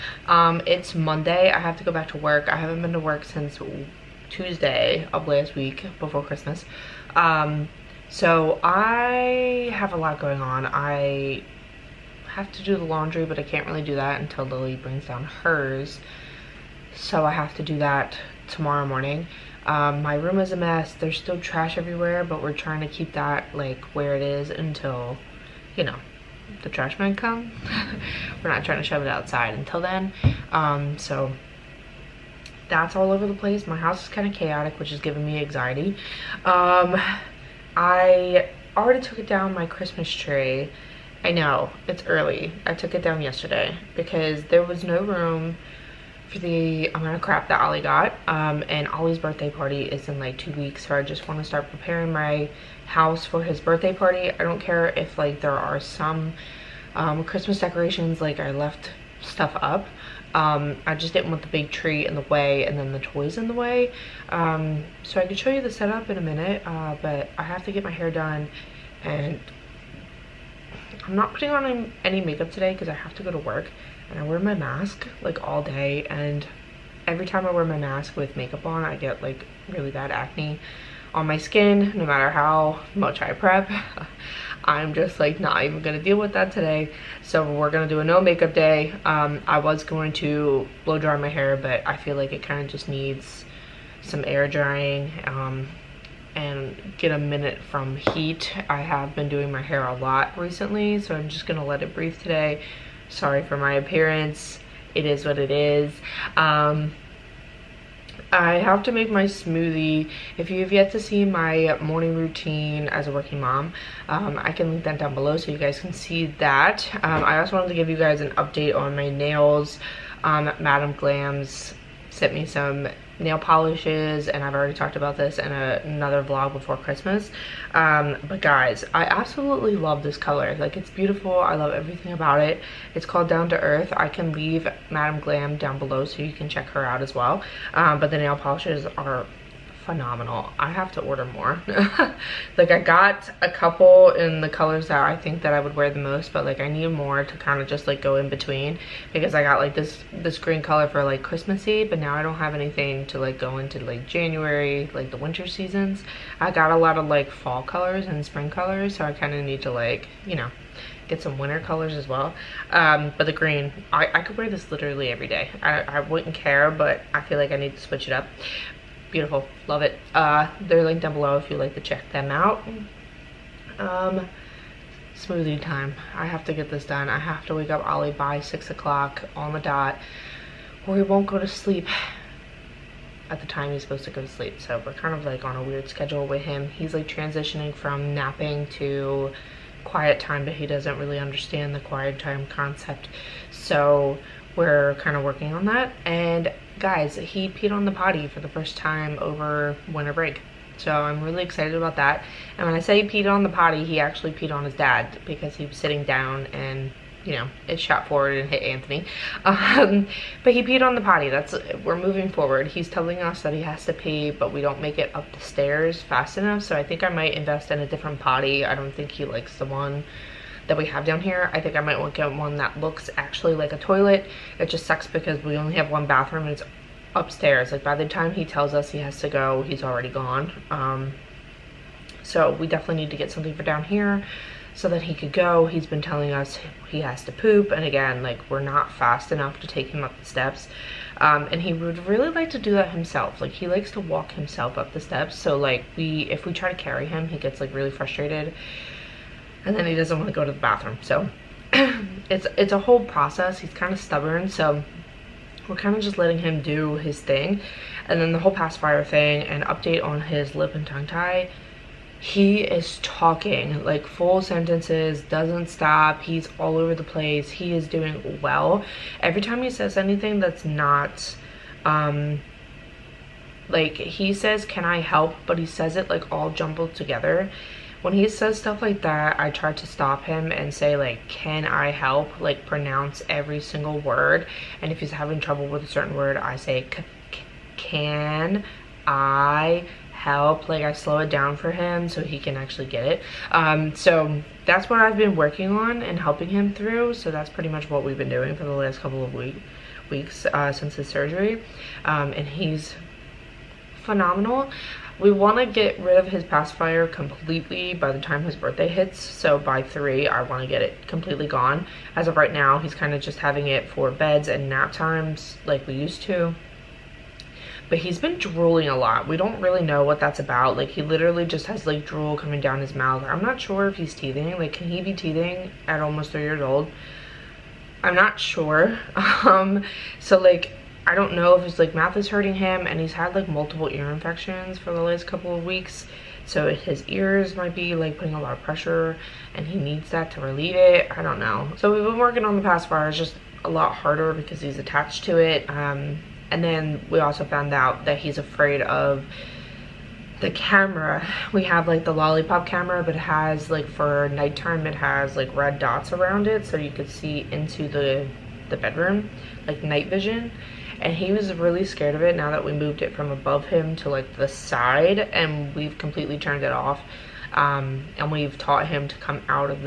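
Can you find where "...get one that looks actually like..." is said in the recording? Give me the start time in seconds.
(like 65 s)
222 s.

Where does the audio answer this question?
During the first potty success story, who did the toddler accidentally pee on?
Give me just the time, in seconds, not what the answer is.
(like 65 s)
208 s.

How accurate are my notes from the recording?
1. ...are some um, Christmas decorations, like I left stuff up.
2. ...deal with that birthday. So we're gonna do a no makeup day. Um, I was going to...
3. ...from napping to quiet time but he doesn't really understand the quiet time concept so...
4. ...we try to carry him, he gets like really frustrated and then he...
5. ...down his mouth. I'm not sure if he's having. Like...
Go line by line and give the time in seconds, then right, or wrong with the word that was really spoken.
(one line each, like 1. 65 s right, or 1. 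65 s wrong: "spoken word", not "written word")
1. 55 s right
2. 86 s wrong: "today", not "birthday"
3. 187 s right
4. 246 s right
5. 322 s wrong: "teething", not "having".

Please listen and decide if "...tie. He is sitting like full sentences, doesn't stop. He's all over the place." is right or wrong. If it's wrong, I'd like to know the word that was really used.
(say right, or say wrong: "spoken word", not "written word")
wrong: "talking", not "sitting".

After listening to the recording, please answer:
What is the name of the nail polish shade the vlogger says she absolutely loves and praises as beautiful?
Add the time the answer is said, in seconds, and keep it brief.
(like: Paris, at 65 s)
Down to Earth, at 133 s.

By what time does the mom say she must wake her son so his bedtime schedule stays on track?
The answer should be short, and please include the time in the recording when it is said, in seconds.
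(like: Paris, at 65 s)
6 o'clock, at 178 s.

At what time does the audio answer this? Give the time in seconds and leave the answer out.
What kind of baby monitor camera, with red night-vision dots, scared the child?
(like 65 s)
352 s.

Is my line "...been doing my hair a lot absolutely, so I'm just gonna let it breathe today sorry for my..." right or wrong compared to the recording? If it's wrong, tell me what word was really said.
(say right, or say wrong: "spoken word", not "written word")
wrong: "recently", not "absolutely".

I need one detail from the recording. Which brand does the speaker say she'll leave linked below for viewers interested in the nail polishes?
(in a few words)
Madam Glam.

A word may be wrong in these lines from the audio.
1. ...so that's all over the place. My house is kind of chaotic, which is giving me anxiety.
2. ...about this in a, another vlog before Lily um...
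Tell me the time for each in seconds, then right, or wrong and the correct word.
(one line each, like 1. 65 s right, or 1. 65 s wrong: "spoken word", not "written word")
1. 30 s right
2. 124 s wrong: "Christmas", not "Lily".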